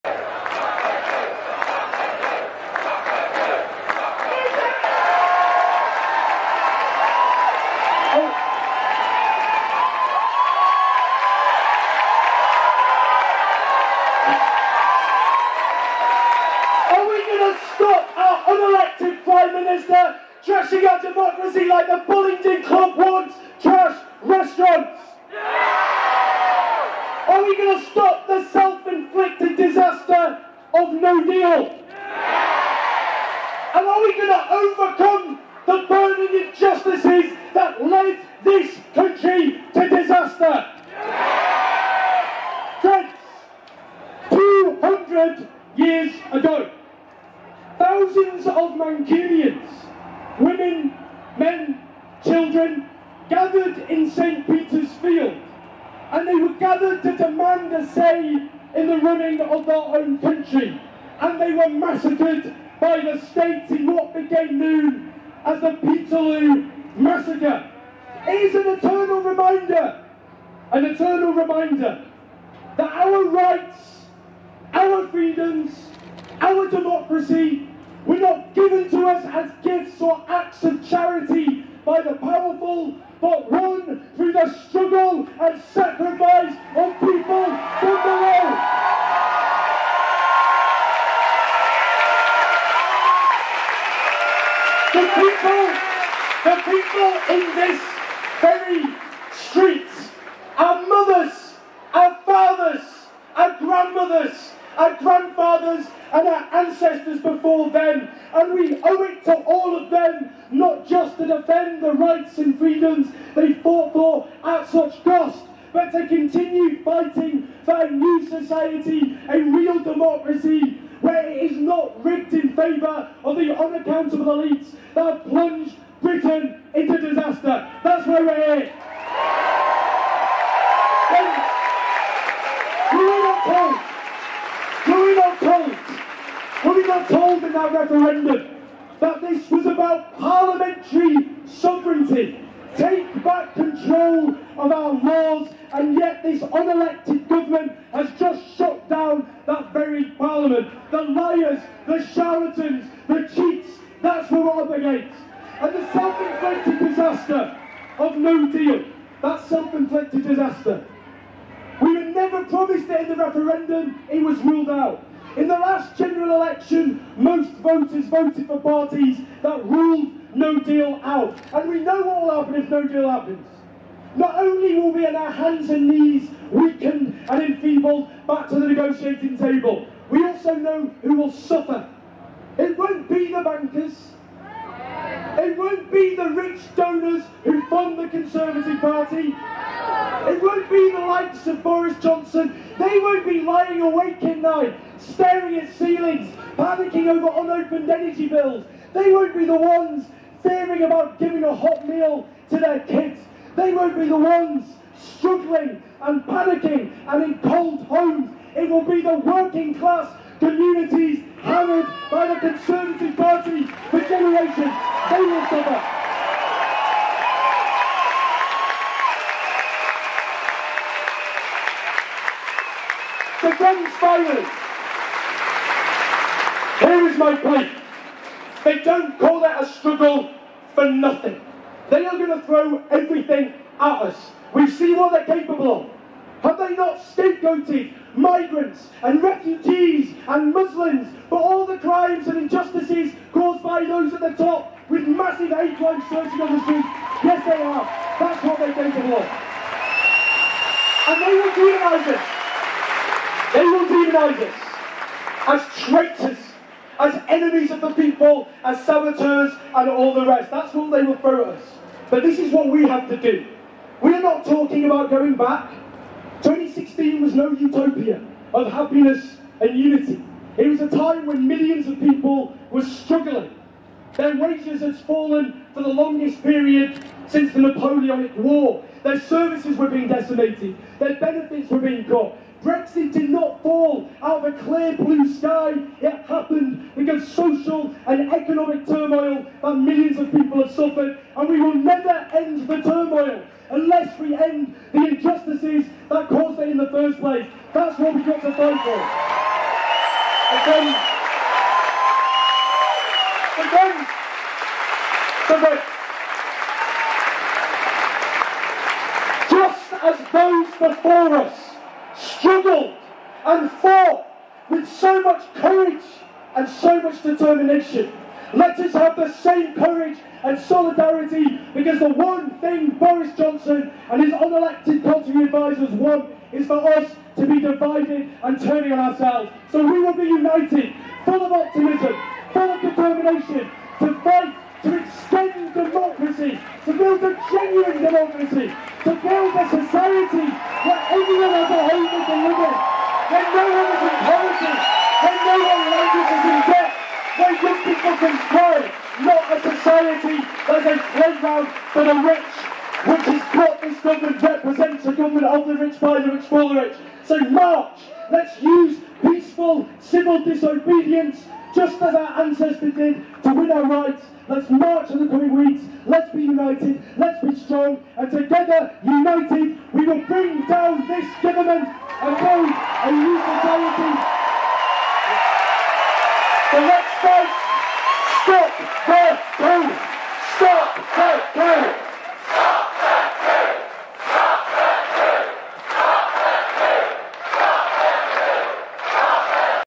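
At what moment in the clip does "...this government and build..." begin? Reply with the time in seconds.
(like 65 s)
371 s.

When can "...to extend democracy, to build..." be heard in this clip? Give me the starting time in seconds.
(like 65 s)
334 s.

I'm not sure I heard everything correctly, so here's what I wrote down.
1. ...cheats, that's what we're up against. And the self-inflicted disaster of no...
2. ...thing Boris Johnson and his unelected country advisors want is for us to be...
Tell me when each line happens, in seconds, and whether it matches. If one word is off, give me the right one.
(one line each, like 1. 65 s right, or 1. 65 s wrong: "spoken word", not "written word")
1. 153 s right
2. 322 s right.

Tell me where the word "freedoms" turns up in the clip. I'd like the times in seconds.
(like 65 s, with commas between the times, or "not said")
75 s, 112 s.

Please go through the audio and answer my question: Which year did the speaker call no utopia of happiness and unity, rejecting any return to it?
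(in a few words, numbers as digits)
2016.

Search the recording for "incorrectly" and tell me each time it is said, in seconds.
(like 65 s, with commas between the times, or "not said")
not said.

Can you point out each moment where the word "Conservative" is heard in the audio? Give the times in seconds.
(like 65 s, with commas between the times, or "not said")
188 s, 212 s.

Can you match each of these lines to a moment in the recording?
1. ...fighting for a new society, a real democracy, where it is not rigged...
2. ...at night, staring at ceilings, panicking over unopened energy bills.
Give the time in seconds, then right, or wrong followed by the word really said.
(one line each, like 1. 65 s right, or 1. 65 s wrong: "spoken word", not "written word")
1. 116 s right
2. 194 s right.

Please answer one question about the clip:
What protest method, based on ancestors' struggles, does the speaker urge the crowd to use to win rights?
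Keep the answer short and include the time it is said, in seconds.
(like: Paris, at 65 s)
peaceful civil disobedience, at 359 s.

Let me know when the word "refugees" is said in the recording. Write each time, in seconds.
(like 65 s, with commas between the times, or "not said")
239 s.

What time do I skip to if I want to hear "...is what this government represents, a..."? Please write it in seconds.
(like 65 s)
353 s.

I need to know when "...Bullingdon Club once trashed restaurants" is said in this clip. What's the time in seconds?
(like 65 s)
22 s.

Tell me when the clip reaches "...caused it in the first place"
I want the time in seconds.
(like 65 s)
296 s.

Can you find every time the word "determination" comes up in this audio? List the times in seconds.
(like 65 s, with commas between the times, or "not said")
317 s, 332 s.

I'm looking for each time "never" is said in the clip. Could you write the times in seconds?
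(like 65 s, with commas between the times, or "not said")
162 s, 291 s.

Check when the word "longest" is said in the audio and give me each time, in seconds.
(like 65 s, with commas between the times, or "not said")
275 s.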